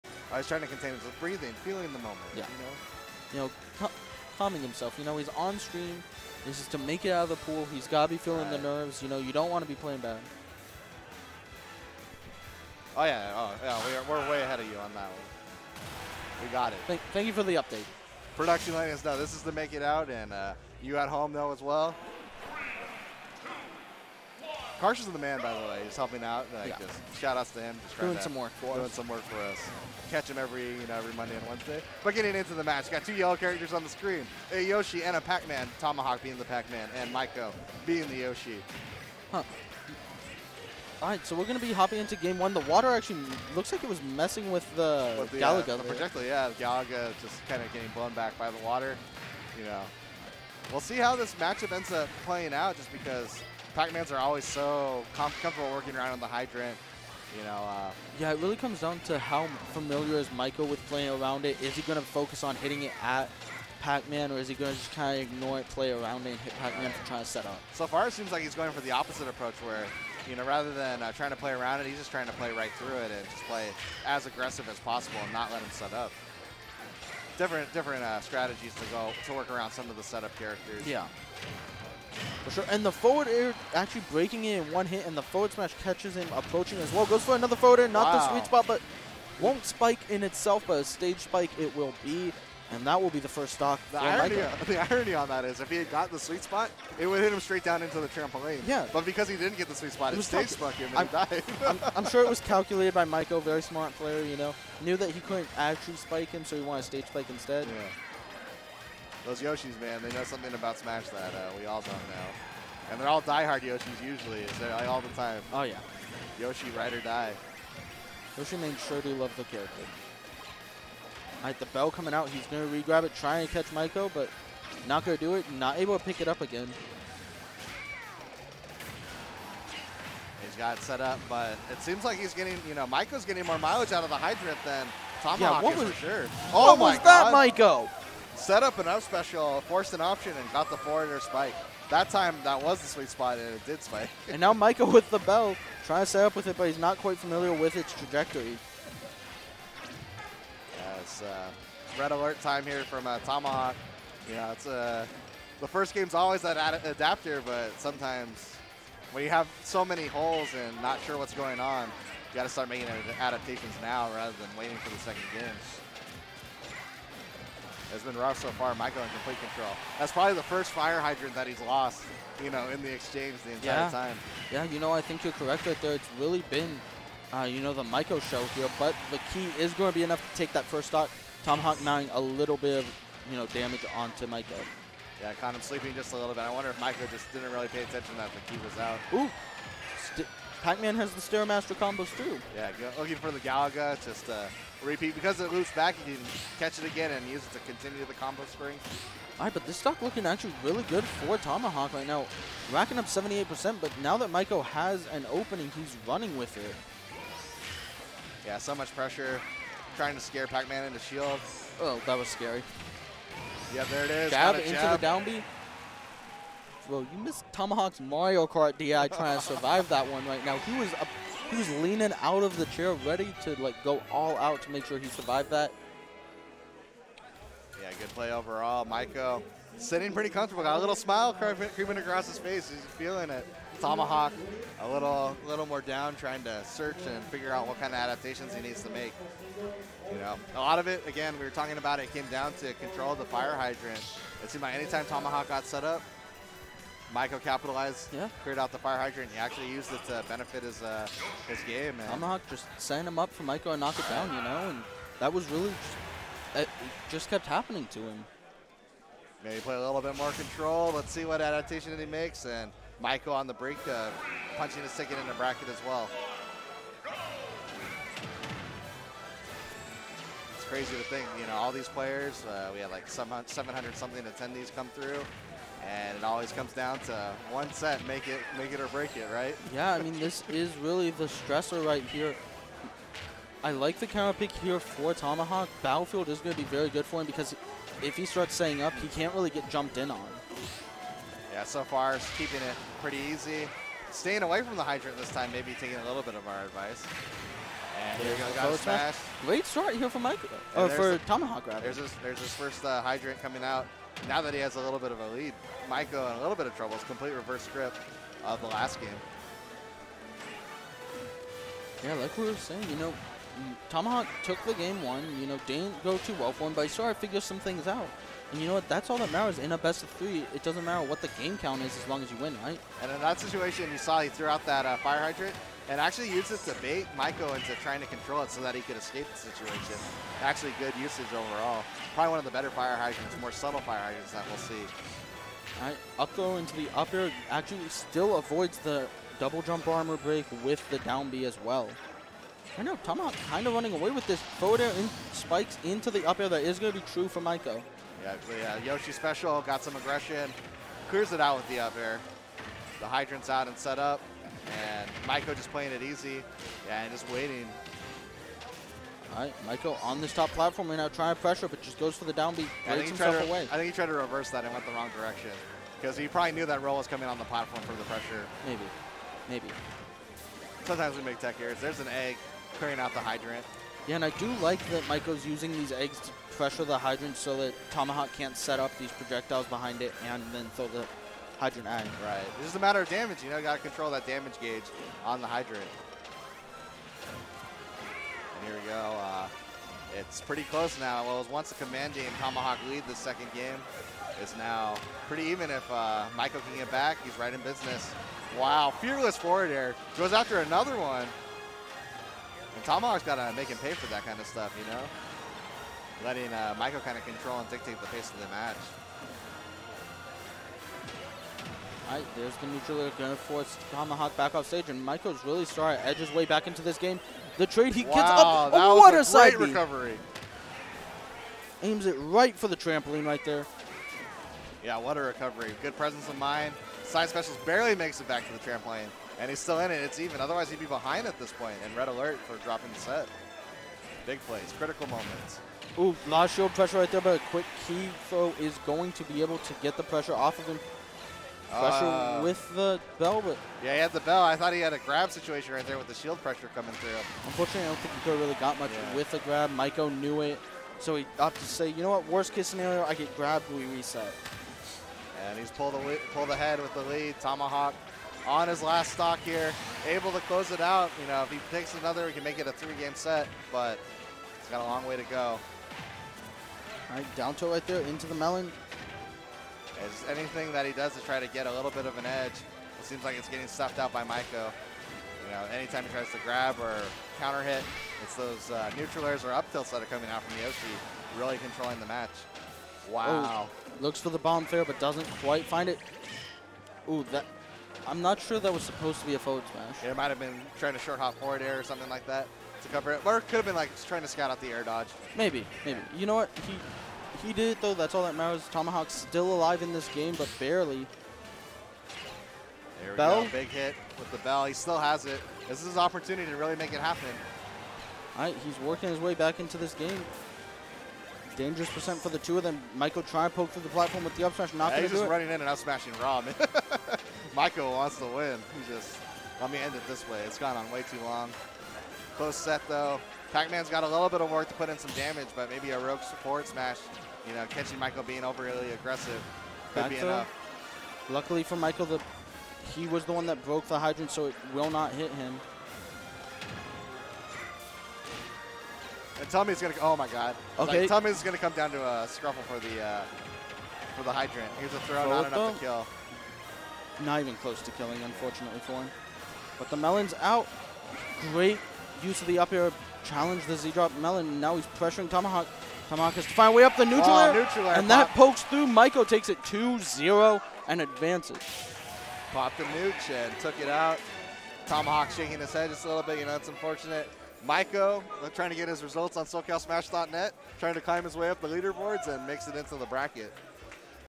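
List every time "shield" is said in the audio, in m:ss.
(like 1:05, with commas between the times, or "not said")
3:30, 7:16, 7:26.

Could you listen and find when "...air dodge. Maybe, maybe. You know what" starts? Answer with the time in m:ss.
8:14.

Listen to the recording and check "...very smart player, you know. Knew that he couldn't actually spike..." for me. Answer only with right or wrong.
right.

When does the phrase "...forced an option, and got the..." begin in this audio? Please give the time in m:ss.
2:19.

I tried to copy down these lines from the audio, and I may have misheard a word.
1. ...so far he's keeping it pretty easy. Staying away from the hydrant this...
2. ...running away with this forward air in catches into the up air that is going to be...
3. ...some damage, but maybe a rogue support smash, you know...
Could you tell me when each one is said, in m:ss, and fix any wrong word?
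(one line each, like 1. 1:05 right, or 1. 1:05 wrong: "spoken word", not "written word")
1. 4:51 right
2. 5:43 wrong: "spikes", not "catches"
3. 8:44 right.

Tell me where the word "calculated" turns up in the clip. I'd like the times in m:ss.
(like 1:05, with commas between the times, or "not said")
1:42.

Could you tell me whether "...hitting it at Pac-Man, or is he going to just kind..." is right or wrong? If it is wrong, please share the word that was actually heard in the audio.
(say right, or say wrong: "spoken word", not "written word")
right.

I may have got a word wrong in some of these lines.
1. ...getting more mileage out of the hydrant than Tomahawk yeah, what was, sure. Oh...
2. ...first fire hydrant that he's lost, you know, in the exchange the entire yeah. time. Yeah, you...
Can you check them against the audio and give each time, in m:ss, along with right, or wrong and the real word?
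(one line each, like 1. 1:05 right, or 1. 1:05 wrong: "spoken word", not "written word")
1. 2:13 right
2. 2:50 right.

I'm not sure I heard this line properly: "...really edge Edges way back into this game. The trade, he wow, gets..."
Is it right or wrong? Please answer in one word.
right.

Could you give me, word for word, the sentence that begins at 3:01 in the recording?
Tomahawk mounting a little bit of, you know, damage onto Maiko.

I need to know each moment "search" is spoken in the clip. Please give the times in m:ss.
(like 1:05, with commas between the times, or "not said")
3:56.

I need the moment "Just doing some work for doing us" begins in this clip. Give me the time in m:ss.
0:27.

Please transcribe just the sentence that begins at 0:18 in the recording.
Production letting us know this is to make it out, and uh, you at home know as well.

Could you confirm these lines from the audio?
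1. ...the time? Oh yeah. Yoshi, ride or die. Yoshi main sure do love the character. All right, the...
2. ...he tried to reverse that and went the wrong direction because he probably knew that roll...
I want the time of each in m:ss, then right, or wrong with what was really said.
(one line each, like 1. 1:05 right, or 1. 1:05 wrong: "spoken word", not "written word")
1. 1:55 right
2. 6:03 right.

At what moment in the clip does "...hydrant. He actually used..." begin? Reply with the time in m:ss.
4:08.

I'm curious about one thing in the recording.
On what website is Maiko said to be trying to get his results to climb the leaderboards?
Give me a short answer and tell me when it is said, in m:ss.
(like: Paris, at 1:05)
SoCalSmash.net, at 9:29.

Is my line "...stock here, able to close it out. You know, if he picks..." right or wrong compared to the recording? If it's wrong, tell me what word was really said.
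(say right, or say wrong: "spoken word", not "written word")
right.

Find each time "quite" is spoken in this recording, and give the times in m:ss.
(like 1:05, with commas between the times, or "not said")
2:26, 8:05.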